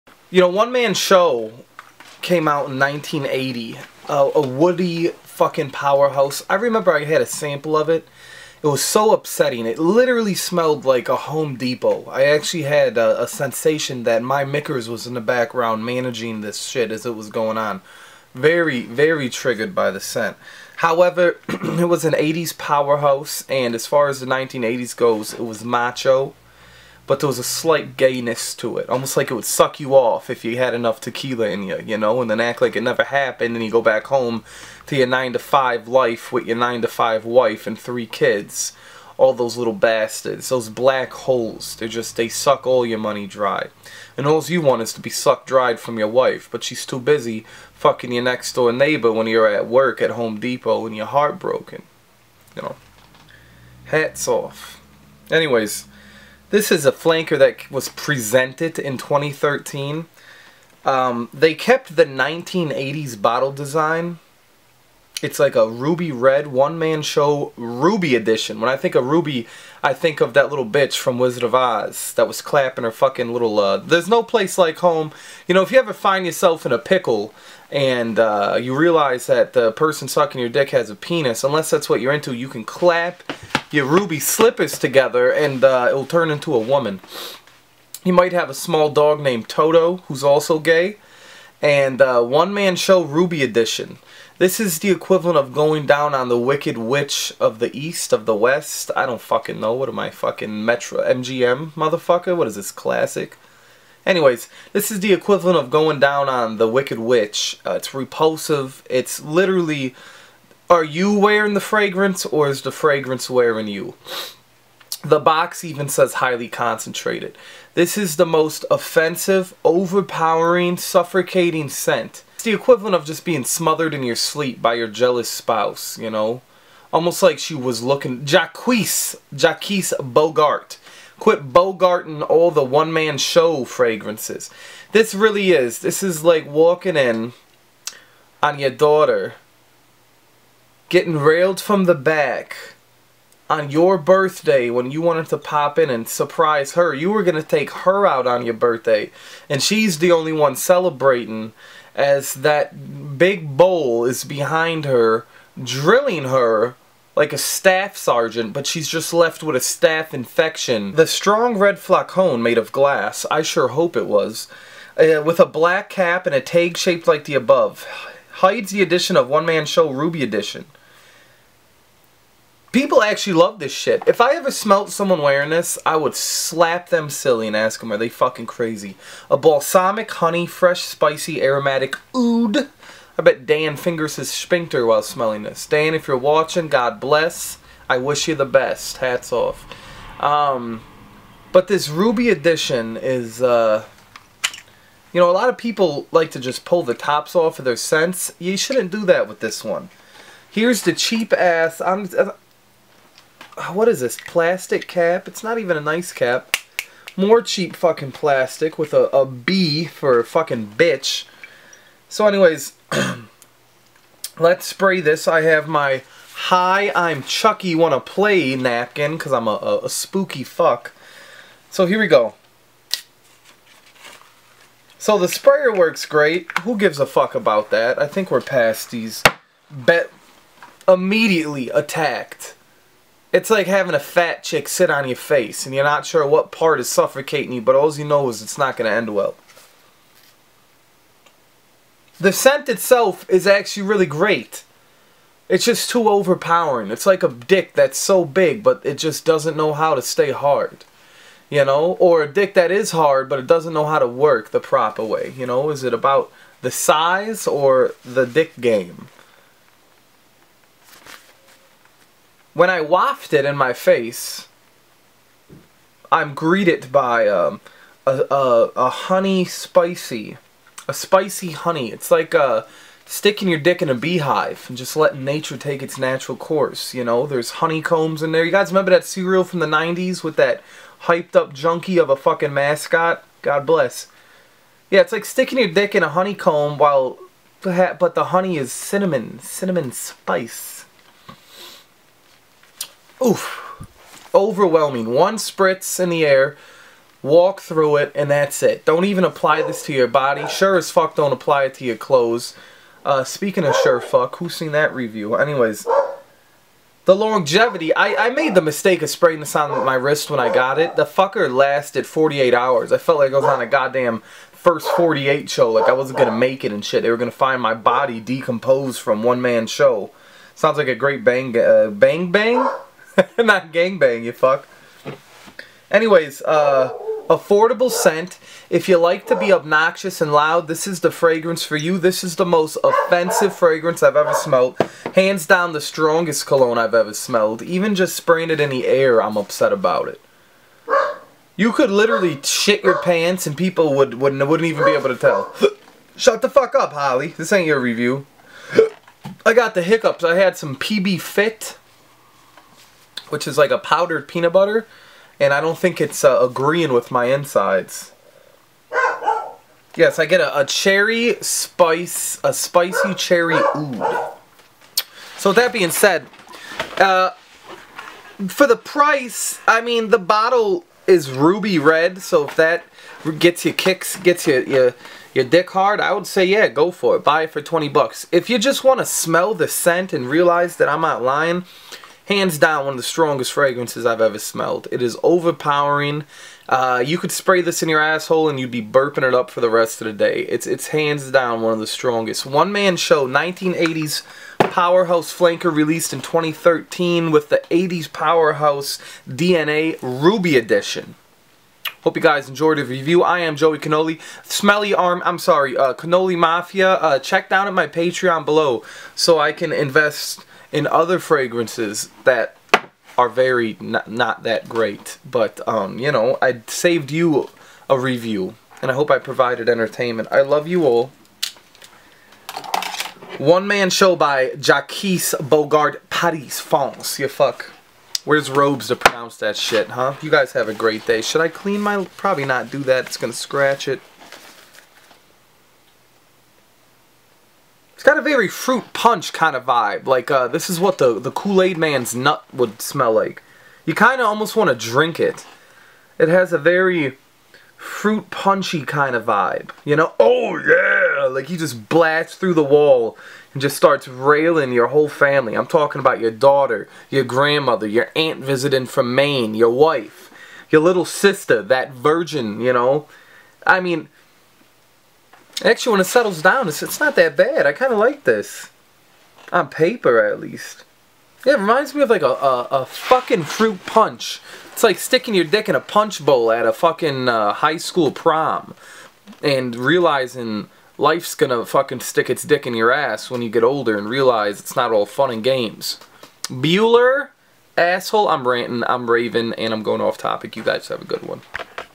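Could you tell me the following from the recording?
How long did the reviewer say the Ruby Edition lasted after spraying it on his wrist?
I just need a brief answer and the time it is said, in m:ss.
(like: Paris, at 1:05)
48 hours, at 5:12.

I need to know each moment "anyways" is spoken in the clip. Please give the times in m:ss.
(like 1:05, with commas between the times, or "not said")
0:55, 1:44, 3:32, 5:05, 5:25.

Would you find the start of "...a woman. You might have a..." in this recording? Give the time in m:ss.
1:26.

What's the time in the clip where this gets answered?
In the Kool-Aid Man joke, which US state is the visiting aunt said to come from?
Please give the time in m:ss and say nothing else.
7:39.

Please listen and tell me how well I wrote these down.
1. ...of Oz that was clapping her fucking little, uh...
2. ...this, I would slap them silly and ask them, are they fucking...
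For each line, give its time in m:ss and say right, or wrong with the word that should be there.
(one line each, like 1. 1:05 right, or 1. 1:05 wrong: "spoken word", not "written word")
1. 1:11 right
2. 2:55 right.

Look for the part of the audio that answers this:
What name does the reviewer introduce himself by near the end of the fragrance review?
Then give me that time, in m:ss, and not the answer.
6:43.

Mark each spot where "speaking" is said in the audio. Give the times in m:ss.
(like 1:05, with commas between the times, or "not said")
5:03.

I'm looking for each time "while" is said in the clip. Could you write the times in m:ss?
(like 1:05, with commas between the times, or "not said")
3:04, 4:46.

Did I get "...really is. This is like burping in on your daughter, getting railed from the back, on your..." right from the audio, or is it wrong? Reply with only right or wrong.
wrong.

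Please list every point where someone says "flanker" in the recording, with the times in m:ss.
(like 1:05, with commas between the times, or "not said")
0:56, 6:35.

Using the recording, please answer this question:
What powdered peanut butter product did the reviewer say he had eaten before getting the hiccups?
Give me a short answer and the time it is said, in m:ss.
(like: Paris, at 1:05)
PB Fit, at 5:50.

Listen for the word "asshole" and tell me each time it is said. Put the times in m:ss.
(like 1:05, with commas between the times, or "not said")
6:28, 8:07.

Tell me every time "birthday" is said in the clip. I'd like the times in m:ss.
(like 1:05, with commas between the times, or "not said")
2:23, 2:28.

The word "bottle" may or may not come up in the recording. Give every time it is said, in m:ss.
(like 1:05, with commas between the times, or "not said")
1:03, 6:10.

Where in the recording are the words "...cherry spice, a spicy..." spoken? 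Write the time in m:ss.
6:00.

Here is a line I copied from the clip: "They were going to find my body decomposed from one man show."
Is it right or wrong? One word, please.
right.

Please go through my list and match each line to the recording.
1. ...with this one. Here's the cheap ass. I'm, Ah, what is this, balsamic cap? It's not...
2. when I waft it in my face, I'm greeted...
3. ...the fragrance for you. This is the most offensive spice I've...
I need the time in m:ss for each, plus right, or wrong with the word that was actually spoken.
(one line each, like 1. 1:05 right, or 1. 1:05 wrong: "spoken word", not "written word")
1. 3:19 wrong: "plastic", not "balsamic"
2. 4:22 right
3. 5:31 wrong: "fragrance", not "spice".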